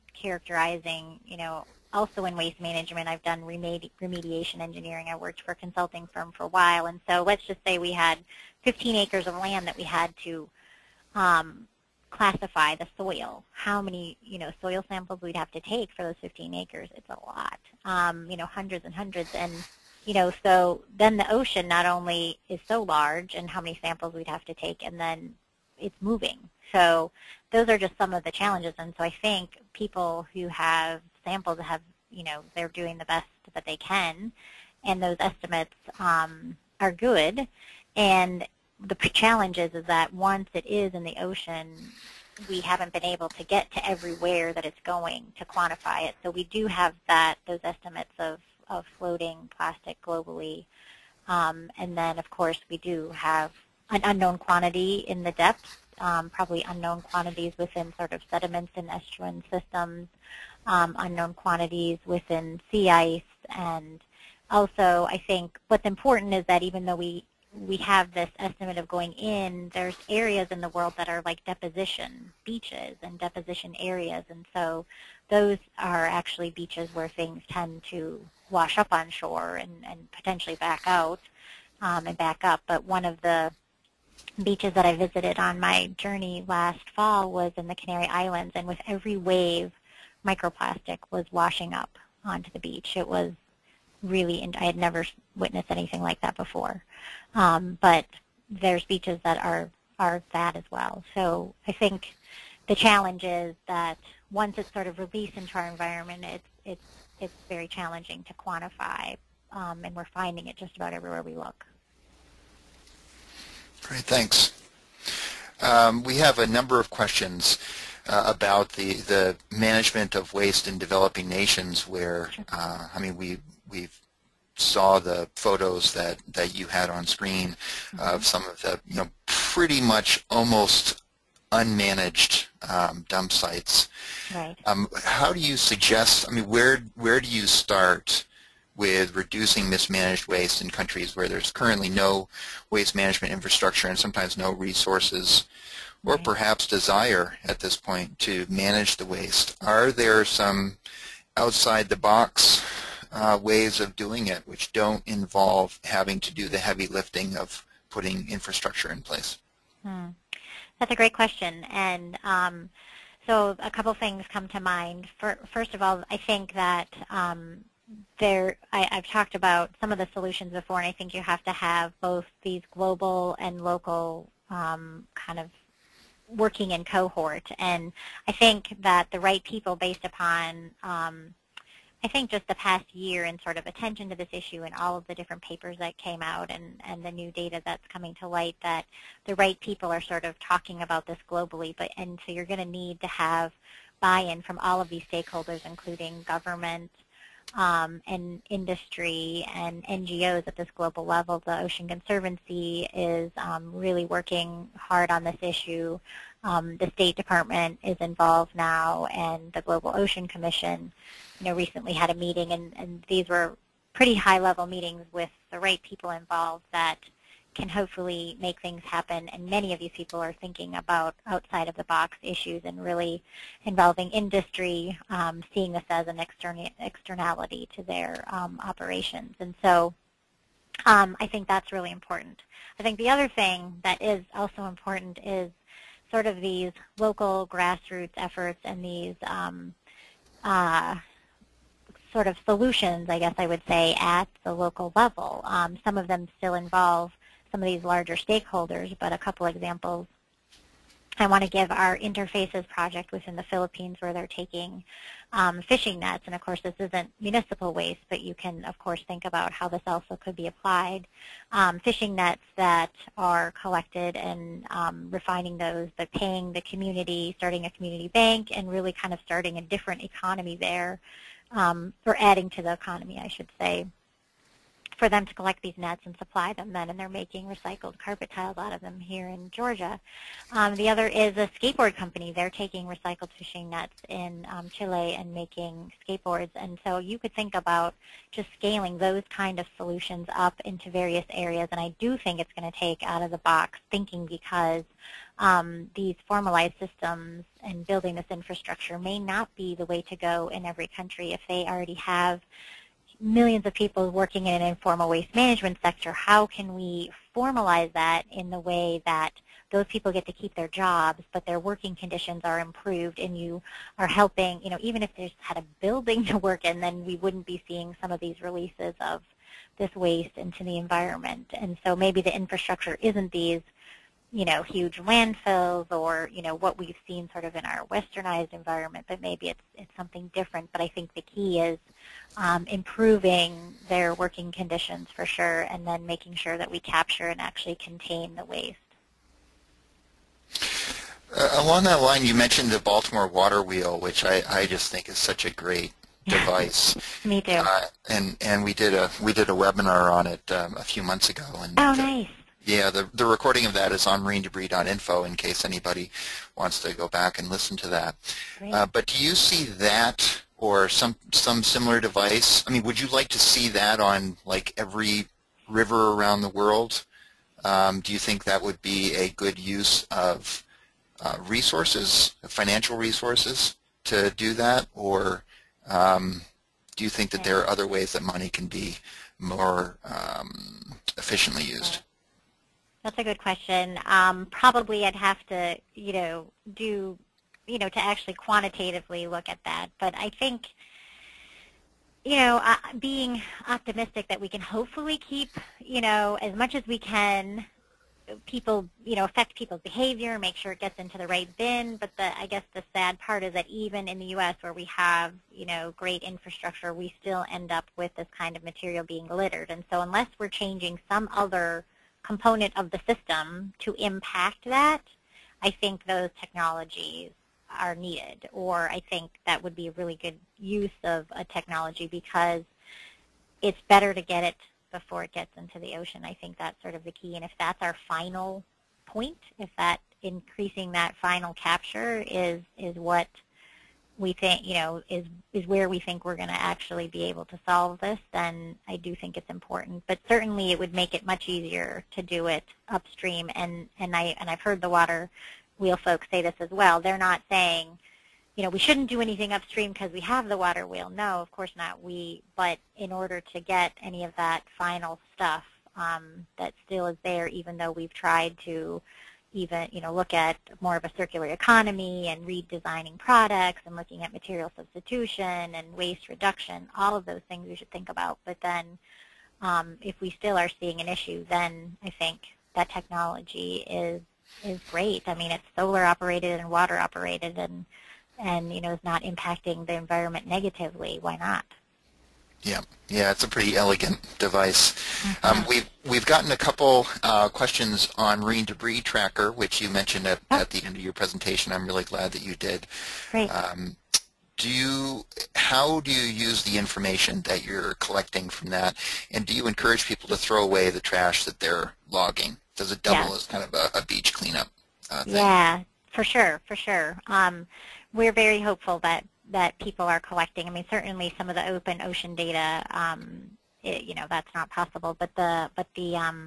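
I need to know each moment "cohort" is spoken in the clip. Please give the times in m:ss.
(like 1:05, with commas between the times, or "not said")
2:56.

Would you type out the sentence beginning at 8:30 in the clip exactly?
I mean, certainly some of the open ocean data, um, it, you know, that's not possible.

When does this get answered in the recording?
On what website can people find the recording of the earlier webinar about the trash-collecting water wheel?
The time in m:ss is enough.
5:54.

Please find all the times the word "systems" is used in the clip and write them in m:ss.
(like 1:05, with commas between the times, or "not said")
0:59, 4:56, 6:53.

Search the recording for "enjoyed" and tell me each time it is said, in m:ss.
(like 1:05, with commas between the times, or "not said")
not said.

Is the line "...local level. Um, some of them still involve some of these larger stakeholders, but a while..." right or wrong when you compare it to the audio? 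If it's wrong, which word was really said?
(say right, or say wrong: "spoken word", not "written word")
wrong: "couple", not "while".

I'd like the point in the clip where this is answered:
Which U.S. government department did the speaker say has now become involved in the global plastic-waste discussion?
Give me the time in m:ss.
3:26.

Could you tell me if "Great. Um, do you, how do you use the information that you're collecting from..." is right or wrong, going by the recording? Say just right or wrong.
right.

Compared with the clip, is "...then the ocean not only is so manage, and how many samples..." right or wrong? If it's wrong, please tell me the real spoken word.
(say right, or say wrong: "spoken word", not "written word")
wrong: "large", not "manage".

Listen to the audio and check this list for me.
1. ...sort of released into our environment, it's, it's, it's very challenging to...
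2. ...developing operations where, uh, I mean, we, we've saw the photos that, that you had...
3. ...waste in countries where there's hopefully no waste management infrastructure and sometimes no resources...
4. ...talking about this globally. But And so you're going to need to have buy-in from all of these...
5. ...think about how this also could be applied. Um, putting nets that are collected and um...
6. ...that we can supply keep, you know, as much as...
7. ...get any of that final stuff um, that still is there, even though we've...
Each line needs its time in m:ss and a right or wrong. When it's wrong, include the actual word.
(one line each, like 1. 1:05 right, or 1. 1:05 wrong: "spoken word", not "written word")
1. 1:44 right
2. 2:00 wrong: "nations", not "operations"
3. 2:20 wrong: "currently", not "hopefully"
4. 3:10 right
5. 4:19 wrong: "fishing", not "putting"
6. 6:34 wrong: "hopefully", not "supply"
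7. 7:33 right.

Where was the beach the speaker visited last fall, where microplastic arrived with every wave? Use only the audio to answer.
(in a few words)
Canary Islands.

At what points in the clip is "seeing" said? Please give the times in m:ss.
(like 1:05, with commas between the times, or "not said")
3:45, 5:17, 7:50.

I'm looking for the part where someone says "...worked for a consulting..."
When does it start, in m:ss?
0:05.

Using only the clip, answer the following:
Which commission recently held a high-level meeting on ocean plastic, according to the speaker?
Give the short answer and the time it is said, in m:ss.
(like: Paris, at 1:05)
Global Ocean Commission, at 3:29.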